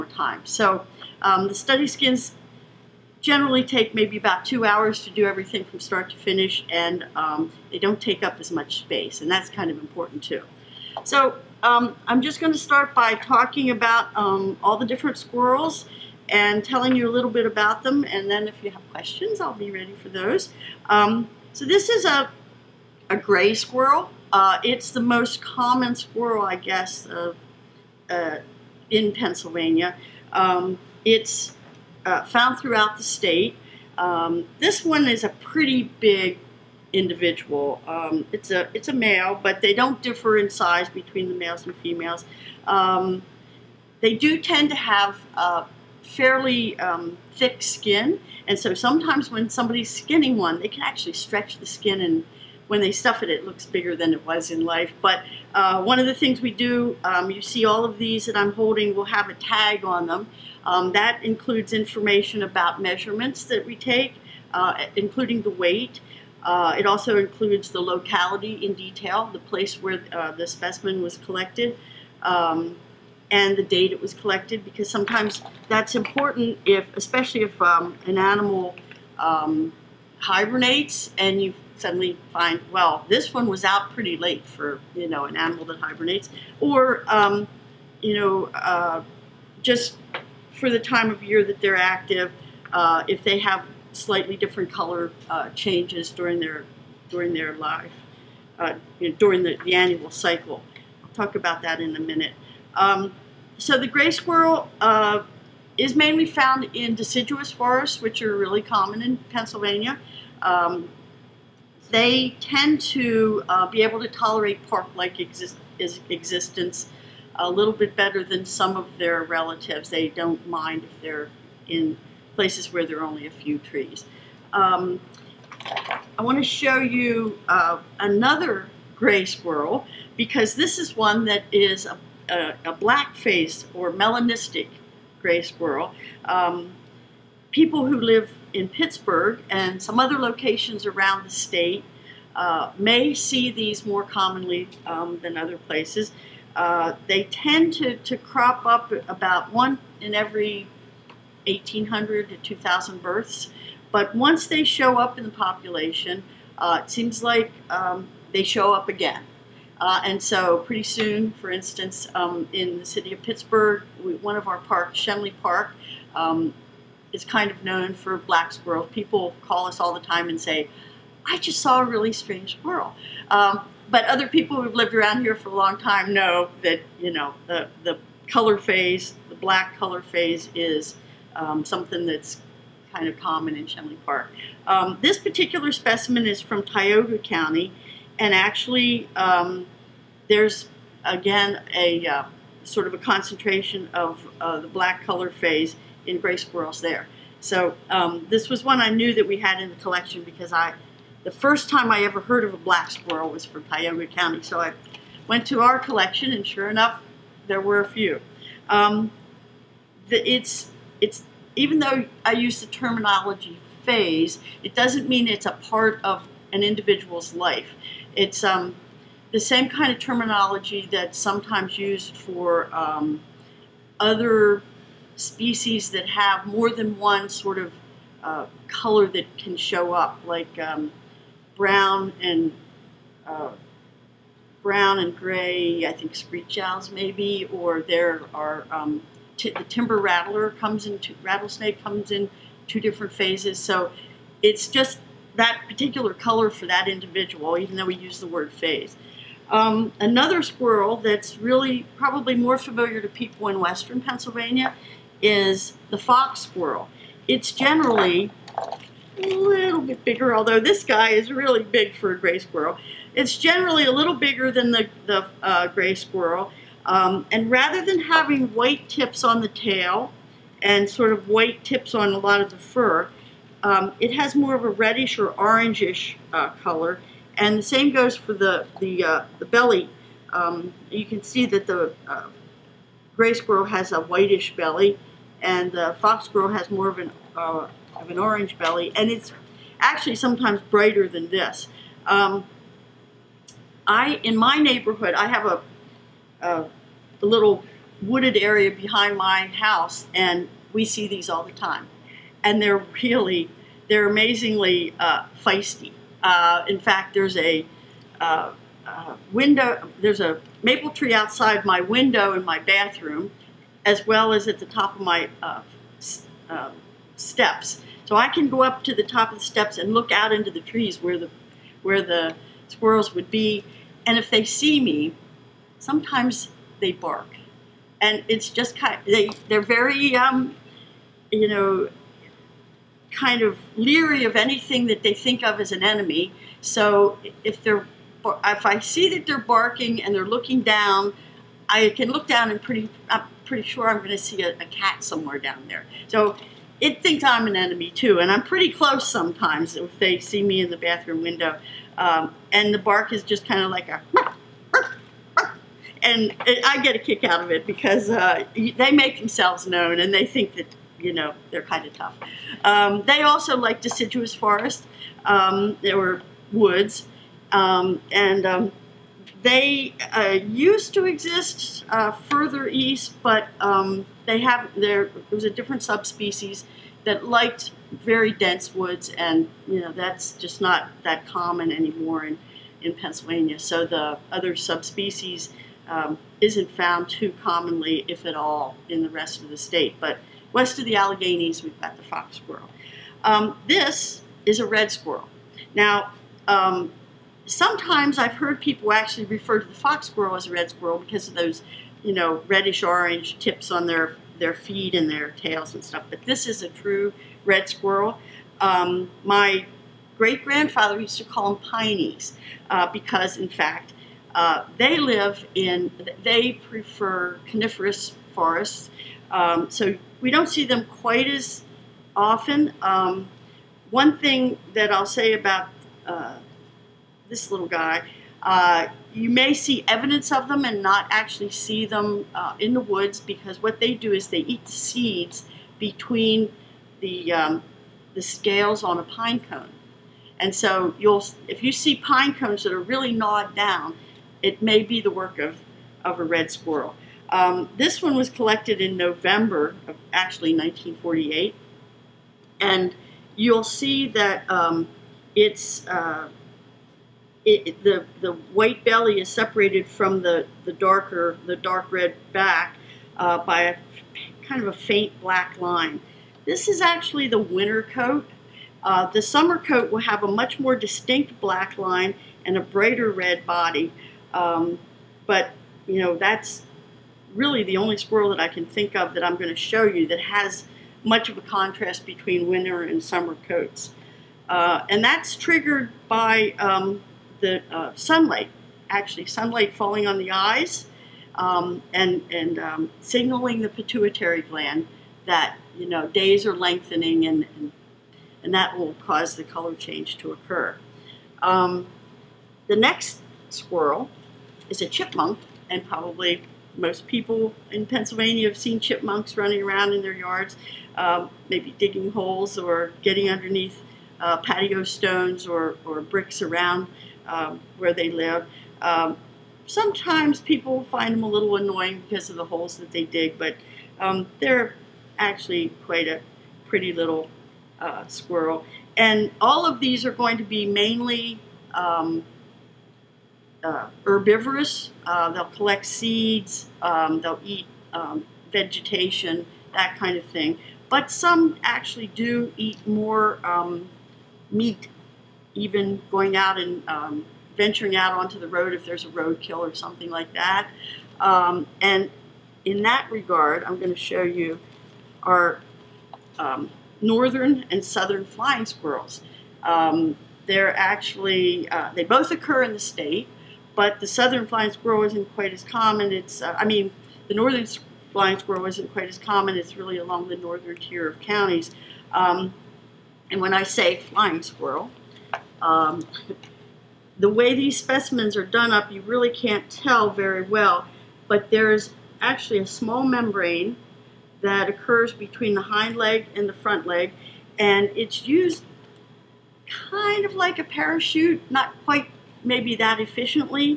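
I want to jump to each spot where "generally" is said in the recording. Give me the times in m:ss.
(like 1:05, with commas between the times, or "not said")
0:03, 4:17, 4:23.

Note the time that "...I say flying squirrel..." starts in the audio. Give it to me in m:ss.
9:33.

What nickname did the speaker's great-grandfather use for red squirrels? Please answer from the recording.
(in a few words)
pineys.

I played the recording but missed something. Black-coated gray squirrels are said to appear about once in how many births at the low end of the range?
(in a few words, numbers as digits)
1,800.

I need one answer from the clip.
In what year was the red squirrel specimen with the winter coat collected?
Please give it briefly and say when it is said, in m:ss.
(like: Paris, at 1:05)
1948, at 7:30.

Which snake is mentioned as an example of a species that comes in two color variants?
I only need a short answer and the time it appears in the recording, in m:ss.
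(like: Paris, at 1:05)
timber rattler, at 3:59.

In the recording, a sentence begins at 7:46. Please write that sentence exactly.
This is actually the winter coat.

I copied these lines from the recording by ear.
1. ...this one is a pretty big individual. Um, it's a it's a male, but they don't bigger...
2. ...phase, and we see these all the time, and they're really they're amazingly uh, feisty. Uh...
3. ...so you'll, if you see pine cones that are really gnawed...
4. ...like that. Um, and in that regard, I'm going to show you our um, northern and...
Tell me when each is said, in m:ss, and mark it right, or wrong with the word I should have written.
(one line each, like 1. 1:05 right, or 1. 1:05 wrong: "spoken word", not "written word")
1. 0:34 wrong: "differ", not "bigger"
2. 4:59 wrong: "house", not "phase"
3. 7:20 right
4. 9:10 right.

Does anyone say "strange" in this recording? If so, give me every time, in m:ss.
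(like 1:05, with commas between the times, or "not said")
2:52.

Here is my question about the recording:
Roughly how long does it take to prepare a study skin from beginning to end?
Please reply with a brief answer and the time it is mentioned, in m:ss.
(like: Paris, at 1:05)
2 hours, at 0:04.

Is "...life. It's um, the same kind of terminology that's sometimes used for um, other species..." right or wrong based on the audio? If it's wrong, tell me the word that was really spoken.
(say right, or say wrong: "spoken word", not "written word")
right.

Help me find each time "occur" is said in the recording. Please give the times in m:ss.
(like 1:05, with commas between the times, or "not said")
8:20, 9:22, 9:44.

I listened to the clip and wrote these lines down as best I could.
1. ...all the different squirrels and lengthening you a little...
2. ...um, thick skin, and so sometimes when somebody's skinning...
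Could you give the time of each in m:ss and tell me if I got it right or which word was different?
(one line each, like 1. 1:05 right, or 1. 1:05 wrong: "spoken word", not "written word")
1. 0:14 wrong: "telling", not "lengthening"
2. 0:46 right.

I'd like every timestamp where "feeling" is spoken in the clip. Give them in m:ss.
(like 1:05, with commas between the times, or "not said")
not said.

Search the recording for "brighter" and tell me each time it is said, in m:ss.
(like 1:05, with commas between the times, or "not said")
4:50, 7:52.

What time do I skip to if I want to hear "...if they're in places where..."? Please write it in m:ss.
2:00.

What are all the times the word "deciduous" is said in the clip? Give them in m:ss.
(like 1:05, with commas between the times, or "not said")
1:46, 6:03.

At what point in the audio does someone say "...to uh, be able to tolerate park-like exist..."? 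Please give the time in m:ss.
1:52.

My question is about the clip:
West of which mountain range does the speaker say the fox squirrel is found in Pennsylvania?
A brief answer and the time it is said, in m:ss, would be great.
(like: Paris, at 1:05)
the Alleghenies, at 6:30.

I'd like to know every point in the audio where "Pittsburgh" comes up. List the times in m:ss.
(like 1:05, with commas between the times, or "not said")
2:18, 2:43.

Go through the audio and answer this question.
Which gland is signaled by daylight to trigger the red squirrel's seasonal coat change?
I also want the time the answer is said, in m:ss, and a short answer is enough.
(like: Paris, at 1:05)
pituitary gland, at 8:13.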